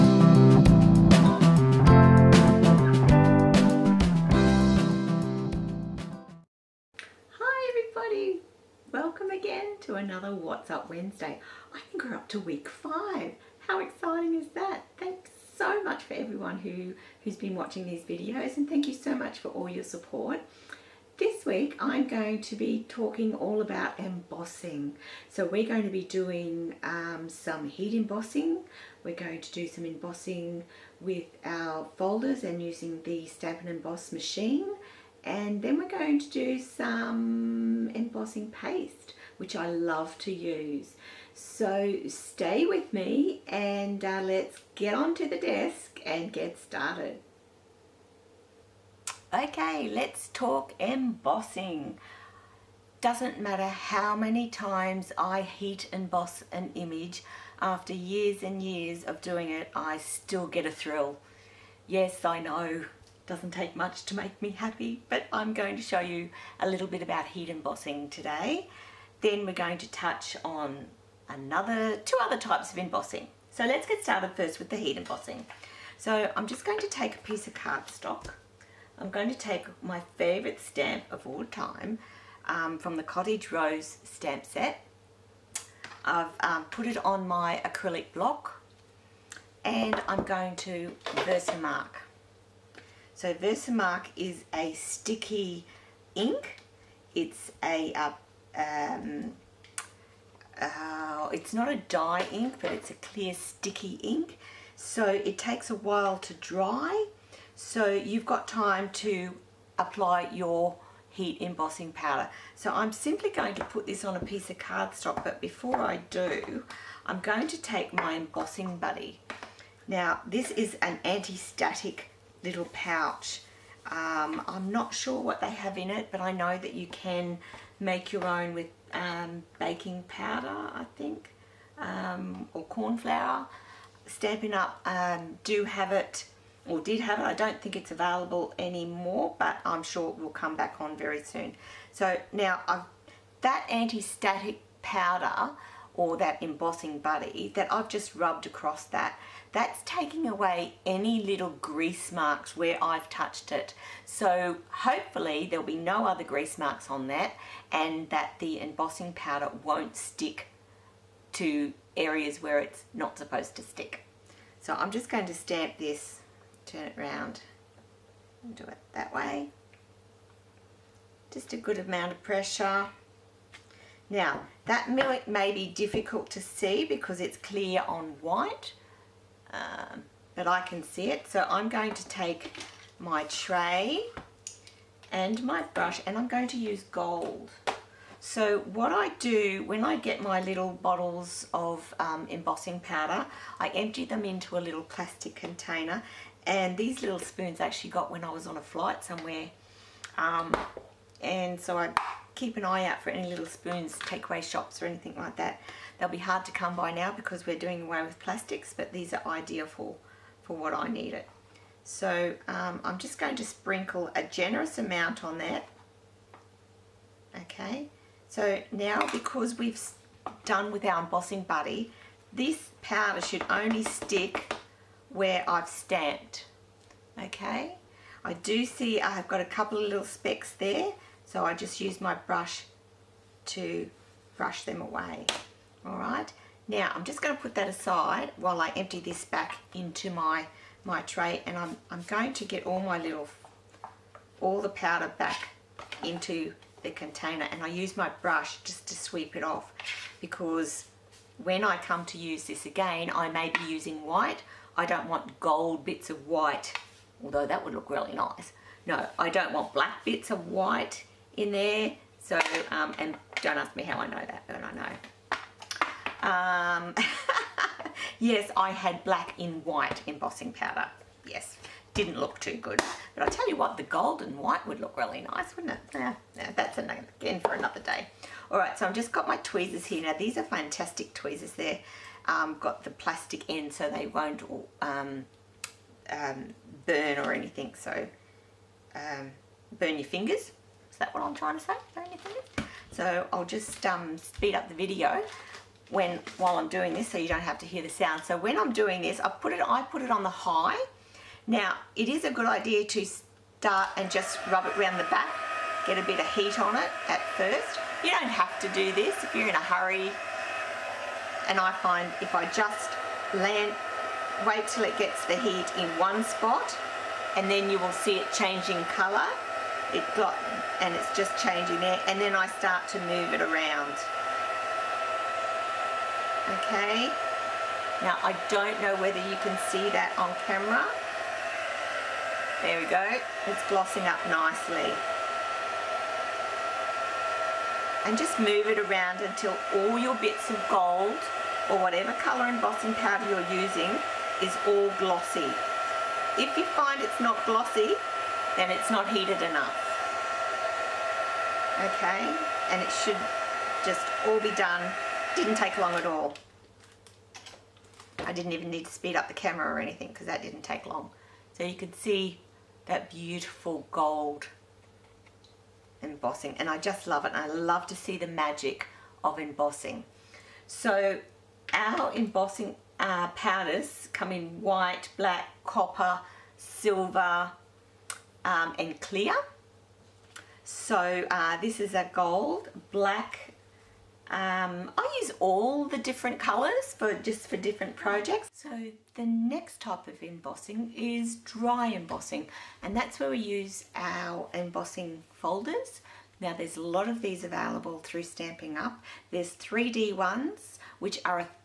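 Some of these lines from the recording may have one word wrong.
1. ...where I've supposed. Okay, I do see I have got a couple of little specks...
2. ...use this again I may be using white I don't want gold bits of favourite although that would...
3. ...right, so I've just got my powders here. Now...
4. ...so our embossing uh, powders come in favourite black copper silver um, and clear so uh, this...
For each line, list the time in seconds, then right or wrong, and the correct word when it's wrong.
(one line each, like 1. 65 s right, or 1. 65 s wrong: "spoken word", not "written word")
1. 225 s wrong: "stamped", not "supposed"
2. 252 s wrong: "white", not "favourite"
3. 278 s wrong: "tweezers", not "powders"
4. 370 s wrong: "white", not "favourite".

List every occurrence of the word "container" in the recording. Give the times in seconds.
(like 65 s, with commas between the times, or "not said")
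195 s, 246 s.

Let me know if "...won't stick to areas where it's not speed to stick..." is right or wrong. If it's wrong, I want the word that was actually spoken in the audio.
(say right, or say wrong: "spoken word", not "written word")
wrong: "supposed", not "speed".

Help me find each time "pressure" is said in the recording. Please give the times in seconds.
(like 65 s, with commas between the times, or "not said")
172 s.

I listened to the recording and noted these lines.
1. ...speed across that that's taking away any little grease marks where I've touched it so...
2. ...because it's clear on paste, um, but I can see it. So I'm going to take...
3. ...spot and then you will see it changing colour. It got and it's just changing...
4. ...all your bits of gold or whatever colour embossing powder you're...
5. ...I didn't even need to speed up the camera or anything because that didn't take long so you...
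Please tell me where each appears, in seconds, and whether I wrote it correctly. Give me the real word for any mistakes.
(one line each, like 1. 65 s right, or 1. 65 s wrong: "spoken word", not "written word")
1. 148 s wrong: "rubbed", not "speed"
2. 176 s wrong: "white", not "paste"
3. 316 s right
4. 339 s right
5. 358 s right.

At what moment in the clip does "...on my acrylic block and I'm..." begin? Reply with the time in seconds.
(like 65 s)
87 s.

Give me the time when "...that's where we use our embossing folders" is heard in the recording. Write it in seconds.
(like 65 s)
392 s.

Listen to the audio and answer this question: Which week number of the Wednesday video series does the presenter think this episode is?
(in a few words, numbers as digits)
5.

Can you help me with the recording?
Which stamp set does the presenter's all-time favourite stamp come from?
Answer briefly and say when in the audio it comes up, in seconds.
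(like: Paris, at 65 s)
Cottage Rose, at 83 s.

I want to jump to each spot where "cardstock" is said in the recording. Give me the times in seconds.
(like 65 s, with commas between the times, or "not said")
77 s, 114 s.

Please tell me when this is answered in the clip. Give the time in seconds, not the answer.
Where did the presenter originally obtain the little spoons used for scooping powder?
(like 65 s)
198 s.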